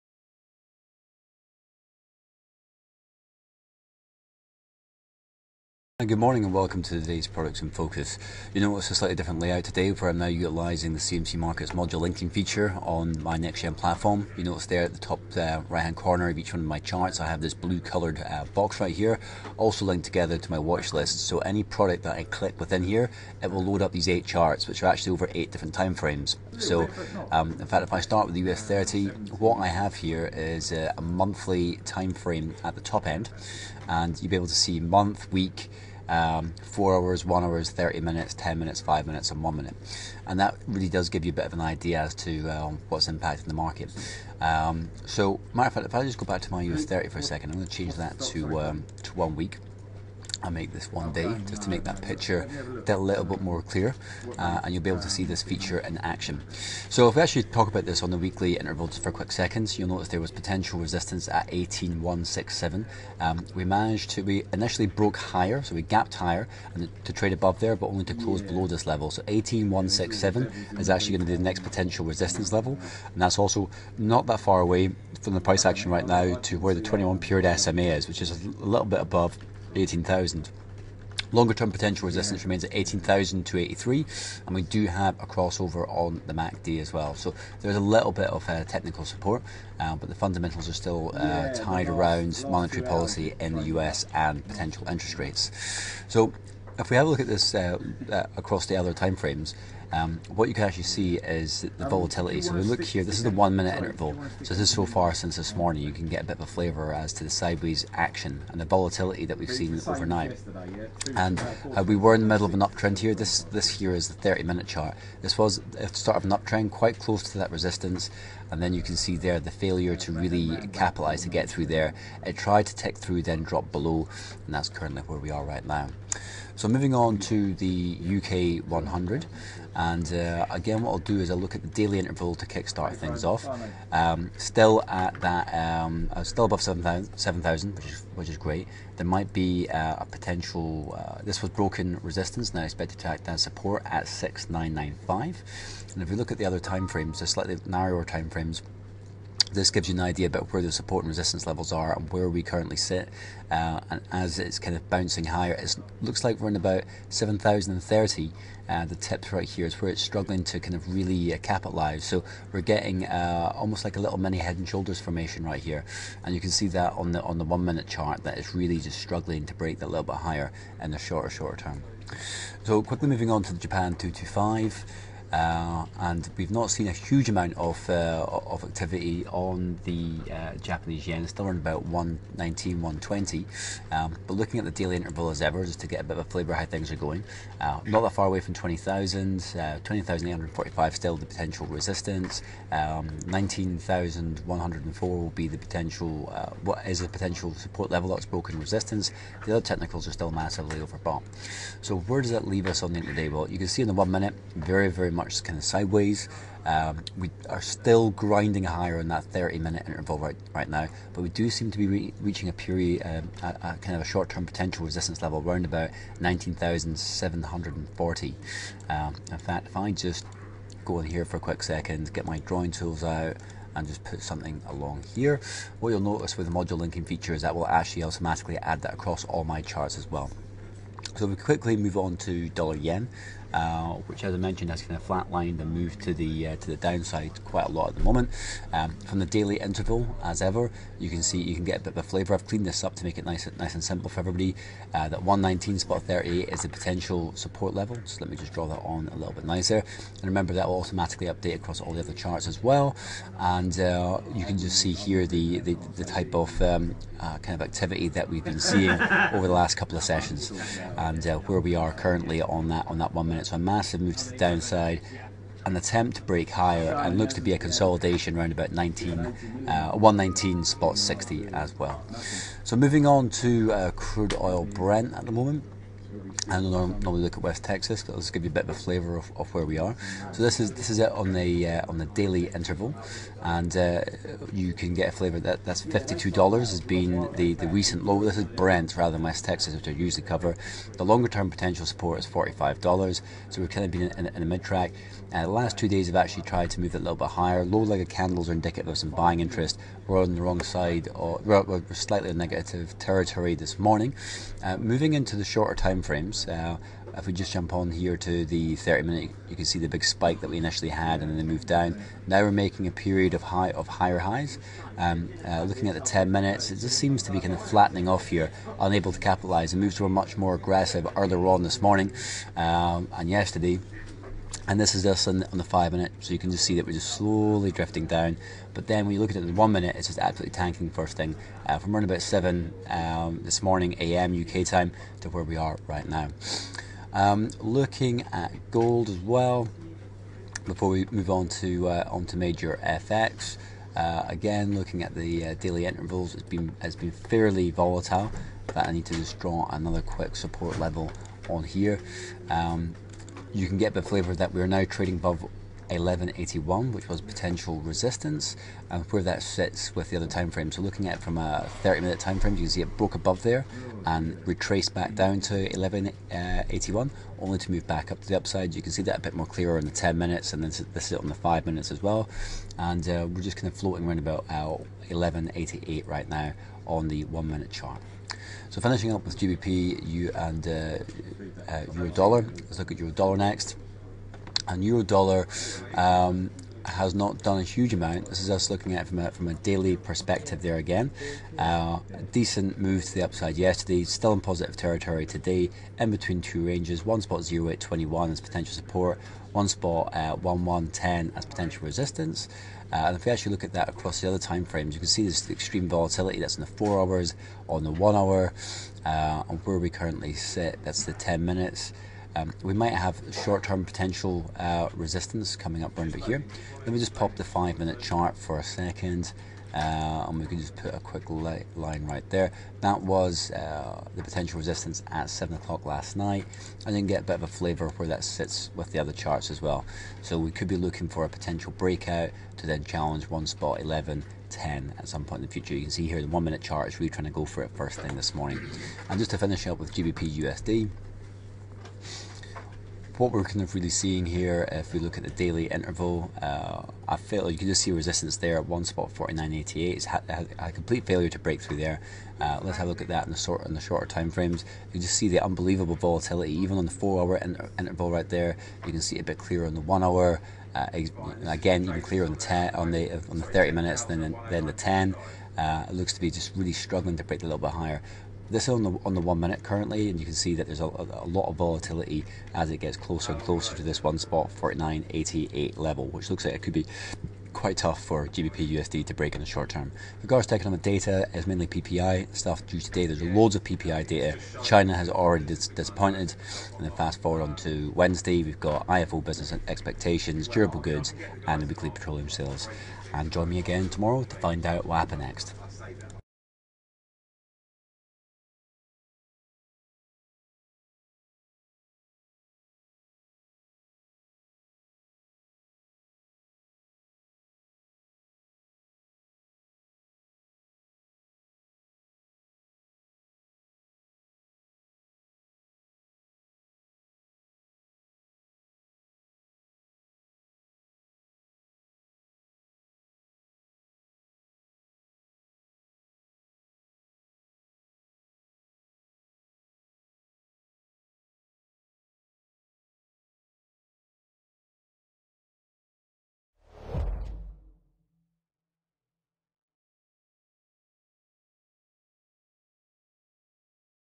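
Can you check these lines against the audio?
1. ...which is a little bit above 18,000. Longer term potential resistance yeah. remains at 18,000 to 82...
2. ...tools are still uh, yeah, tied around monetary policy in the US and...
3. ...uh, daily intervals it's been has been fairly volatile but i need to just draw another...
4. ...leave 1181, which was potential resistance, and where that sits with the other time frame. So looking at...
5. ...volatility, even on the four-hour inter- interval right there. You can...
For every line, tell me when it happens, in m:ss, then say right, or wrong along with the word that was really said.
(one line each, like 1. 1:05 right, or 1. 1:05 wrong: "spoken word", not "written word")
1. 1:18 wrong: "83", not "82"
2. 1:30 wrong: "fundamentals", not "tools"
3. 5:45 right
4. 5:55 wrong: "above", not "leave"
5. 7:35 right.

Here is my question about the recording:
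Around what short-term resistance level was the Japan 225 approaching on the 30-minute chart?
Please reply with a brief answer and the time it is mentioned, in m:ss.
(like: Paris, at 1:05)
19,740, at 3:36.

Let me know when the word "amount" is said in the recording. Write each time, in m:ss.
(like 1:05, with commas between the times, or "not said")
2:57, 6:27.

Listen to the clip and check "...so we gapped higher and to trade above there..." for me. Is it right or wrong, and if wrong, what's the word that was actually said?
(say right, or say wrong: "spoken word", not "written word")
right.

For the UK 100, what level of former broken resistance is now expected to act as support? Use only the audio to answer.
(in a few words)
6,995.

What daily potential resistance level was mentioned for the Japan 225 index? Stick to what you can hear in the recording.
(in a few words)
20,845.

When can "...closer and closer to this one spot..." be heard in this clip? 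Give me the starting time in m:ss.
7:52.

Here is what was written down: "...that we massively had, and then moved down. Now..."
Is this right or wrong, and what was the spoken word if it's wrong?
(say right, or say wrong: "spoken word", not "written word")
wrong: "initially", not "massively".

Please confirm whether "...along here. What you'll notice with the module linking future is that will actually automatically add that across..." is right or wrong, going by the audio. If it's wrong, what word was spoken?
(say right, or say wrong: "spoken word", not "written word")
wrong: "feature", not "future".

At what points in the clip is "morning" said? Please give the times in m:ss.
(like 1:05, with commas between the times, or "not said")
0:06, 1:45, 5:03, 5:21, 5:33, 7:18.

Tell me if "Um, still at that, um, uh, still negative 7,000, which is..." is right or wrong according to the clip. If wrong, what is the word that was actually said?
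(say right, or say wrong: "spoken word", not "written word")
wrong: "above", not "negative".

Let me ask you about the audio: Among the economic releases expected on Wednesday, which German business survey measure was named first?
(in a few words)
IFO business expectations.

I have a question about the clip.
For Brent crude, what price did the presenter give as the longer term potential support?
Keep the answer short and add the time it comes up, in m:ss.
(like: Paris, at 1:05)
$45, at 4:52.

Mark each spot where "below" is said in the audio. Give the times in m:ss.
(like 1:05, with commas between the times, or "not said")
1:08, 2:03.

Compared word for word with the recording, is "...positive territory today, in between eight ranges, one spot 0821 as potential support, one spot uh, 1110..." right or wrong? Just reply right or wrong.
wrong.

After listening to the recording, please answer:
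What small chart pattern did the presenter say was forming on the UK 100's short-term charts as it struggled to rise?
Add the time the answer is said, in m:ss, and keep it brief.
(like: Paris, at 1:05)
head and shoulders, at 2:44.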